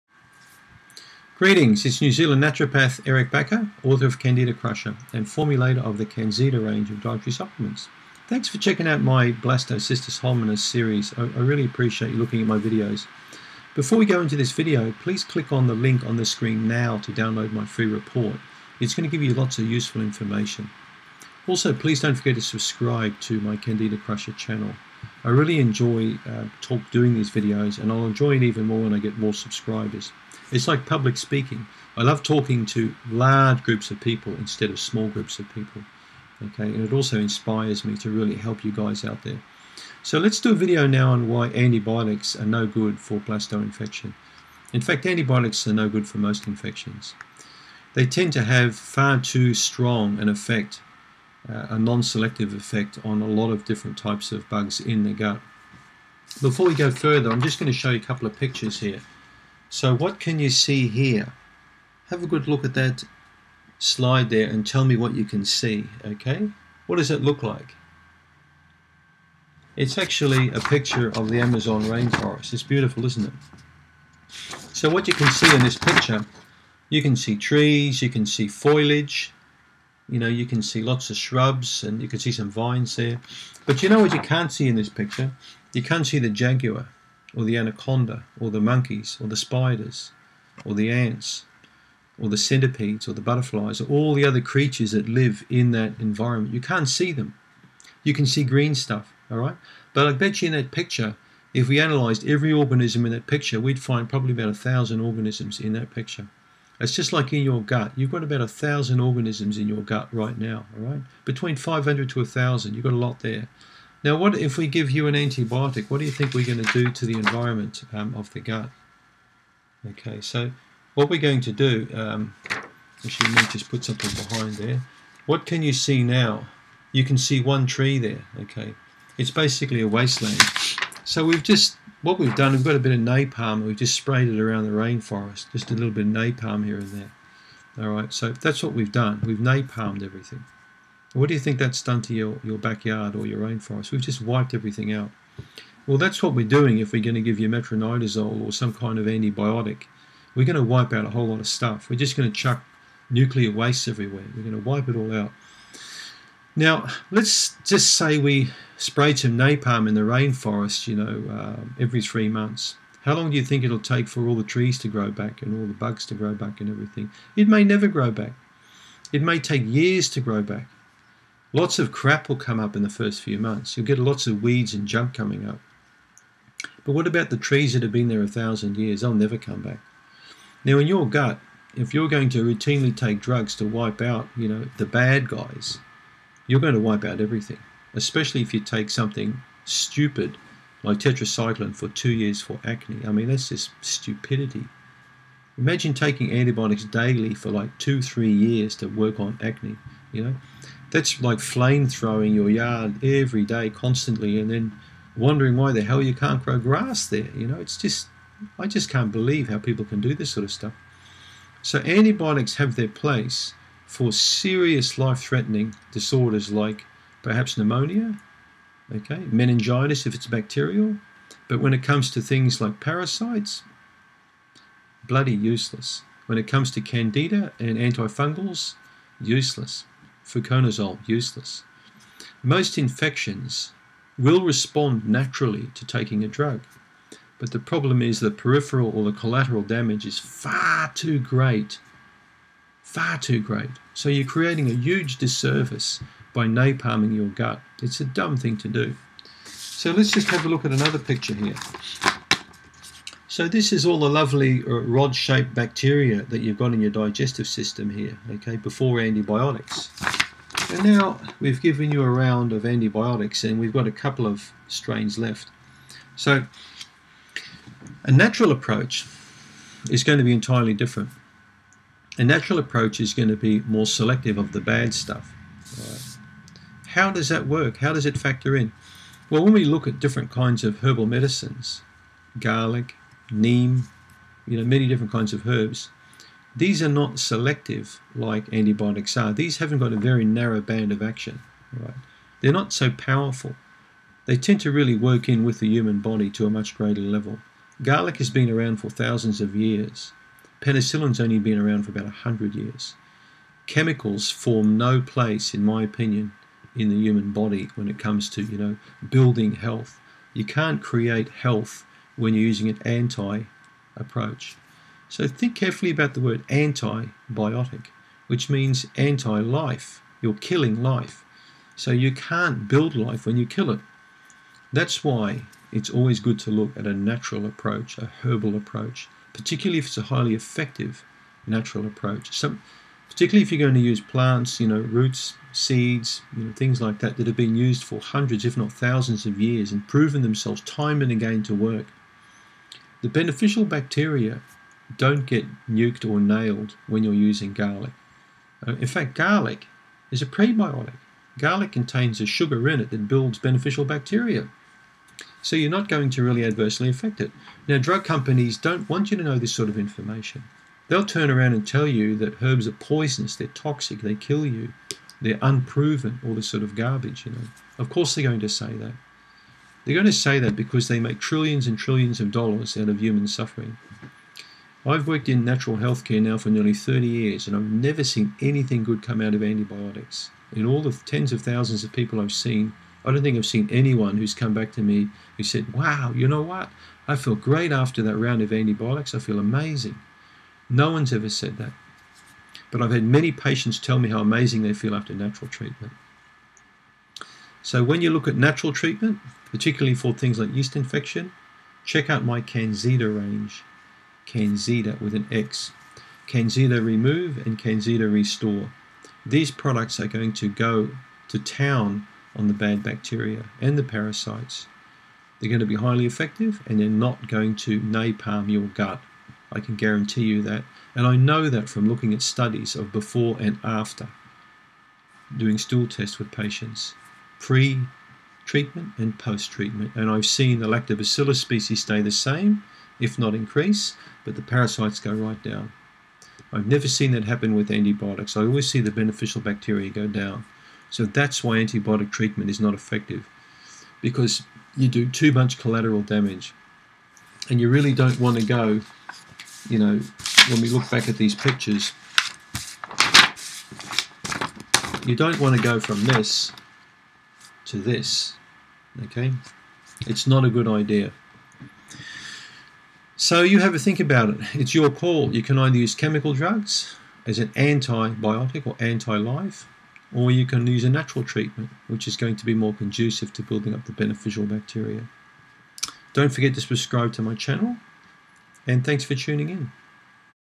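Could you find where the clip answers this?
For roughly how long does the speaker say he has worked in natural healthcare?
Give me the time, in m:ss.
6:16.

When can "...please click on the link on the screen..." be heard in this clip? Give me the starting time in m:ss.
0:15.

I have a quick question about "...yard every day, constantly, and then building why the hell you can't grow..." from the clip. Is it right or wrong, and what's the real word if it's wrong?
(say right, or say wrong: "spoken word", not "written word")
wrong: "wondering", not "building".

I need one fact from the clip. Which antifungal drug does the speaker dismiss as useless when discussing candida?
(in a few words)
fluconazole.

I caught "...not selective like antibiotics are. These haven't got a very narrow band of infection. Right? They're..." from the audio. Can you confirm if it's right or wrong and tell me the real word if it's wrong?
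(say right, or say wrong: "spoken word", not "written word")
wrong: "action", not "infection".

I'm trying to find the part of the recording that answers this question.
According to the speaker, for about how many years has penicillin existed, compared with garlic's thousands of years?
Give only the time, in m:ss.
5:01.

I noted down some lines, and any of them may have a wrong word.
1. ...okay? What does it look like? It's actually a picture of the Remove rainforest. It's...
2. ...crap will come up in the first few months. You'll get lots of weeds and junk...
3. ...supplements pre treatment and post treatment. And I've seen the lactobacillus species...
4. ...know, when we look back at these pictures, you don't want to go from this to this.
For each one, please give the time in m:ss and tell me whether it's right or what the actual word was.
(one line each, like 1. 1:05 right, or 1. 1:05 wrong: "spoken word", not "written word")
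1. 1:06 wrong: "Amazon", not "Remove"
2. 2:51 right
3. 7:06 wrong: "patients", not "supplements"
4. 7:29 right.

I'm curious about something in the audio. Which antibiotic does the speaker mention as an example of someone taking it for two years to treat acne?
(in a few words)
tetracycline.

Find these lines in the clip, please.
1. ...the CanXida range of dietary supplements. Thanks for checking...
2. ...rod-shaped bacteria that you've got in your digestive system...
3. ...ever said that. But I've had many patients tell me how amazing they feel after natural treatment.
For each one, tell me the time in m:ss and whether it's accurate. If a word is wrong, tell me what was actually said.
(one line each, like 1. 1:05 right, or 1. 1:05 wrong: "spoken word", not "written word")
1. 0:05 right
2. 4:14 right
3. 6:31 right.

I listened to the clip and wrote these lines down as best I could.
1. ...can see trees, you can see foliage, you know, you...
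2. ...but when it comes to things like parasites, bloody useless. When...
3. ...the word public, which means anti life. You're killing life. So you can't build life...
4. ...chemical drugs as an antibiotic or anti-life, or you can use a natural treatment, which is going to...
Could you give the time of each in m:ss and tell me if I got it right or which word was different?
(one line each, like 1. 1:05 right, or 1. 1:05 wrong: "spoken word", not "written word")
1. 1:17 right
2. 3:41 right
3. 5:16 wrong: "antibiotic", not "public"
4. 7:45 right.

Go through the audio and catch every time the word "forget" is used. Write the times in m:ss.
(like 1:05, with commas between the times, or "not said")
0:22, 7:56.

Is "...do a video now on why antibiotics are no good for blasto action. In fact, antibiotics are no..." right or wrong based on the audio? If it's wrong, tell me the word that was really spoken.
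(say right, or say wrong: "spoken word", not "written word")
wrong: "infection", not "action".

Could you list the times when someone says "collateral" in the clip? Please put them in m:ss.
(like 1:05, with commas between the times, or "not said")
3:59, 7:25.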